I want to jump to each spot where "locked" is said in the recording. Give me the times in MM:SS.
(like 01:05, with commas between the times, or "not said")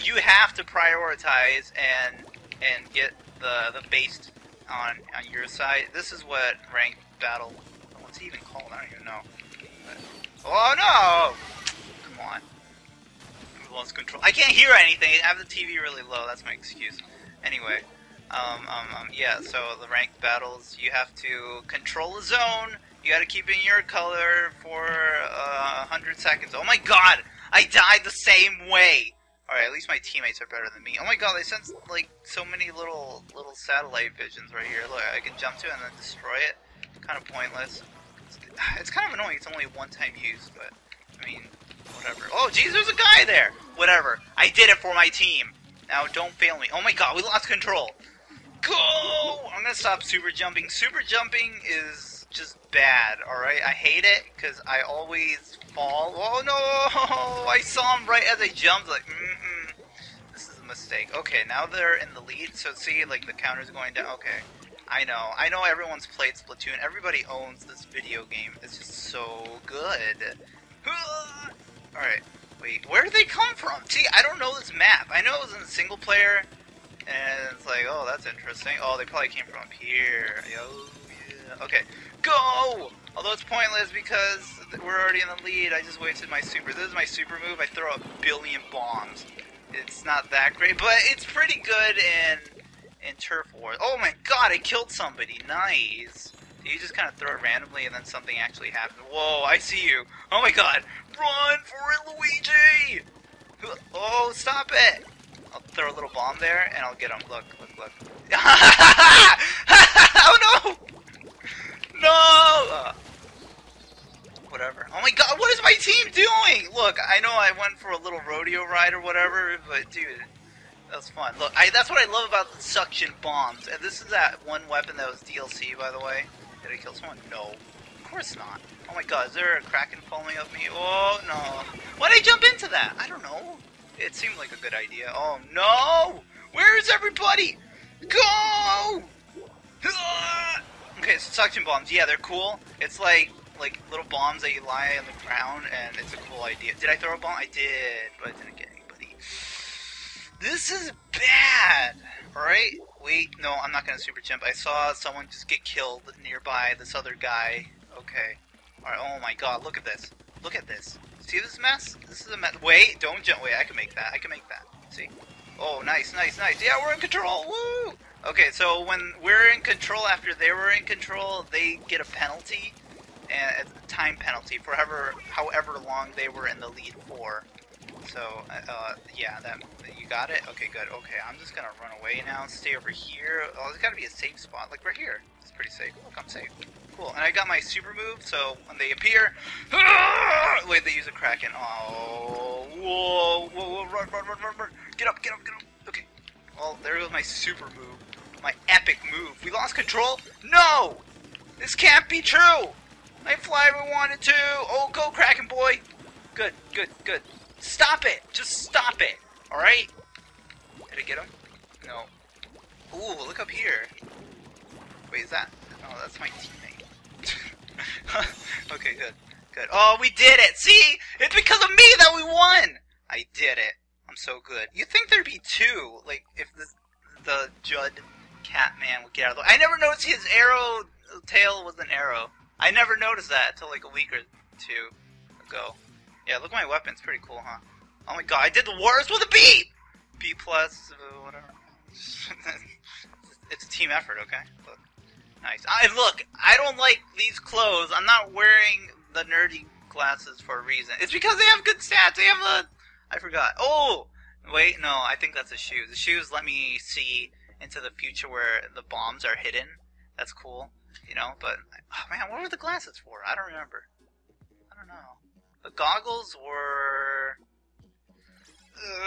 not said.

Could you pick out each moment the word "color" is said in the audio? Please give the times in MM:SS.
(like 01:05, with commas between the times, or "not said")
00:23.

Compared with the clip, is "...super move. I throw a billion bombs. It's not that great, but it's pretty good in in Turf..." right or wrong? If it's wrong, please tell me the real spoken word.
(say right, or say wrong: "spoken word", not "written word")
right.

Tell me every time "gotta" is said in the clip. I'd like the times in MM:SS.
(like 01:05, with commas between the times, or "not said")
00:23, 03:03.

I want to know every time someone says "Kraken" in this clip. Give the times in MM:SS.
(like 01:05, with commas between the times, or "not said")
02:09, 03:11, 03:25.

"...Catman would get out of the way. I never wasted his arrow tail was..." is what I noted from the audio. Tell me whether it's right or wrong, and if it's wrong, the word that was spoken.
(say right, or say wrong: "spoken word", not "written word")
wrong: "noticed", not "wasted".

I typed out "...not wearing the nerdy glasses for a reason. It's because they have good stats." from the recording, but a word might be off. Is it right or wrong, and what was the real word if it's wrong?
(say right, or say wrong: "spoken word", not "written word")
right.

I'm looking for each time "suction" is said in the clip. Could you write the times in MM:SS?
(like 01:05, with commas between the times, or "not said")
02:02, 02:21.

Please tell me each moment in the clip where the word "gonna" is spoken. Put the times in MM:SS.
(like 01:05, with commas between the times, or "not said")
00:49, 02:33, 03:01.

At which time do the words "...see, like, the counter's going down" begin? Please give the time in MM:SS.
01:02.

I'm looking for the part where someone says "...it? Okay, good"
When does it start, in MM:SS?
03:00.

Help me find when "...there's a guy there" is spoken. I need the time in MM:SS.
00:42.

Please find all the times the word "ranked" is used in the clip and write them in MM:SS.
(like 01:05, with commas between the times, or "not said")
00:06, 00:19.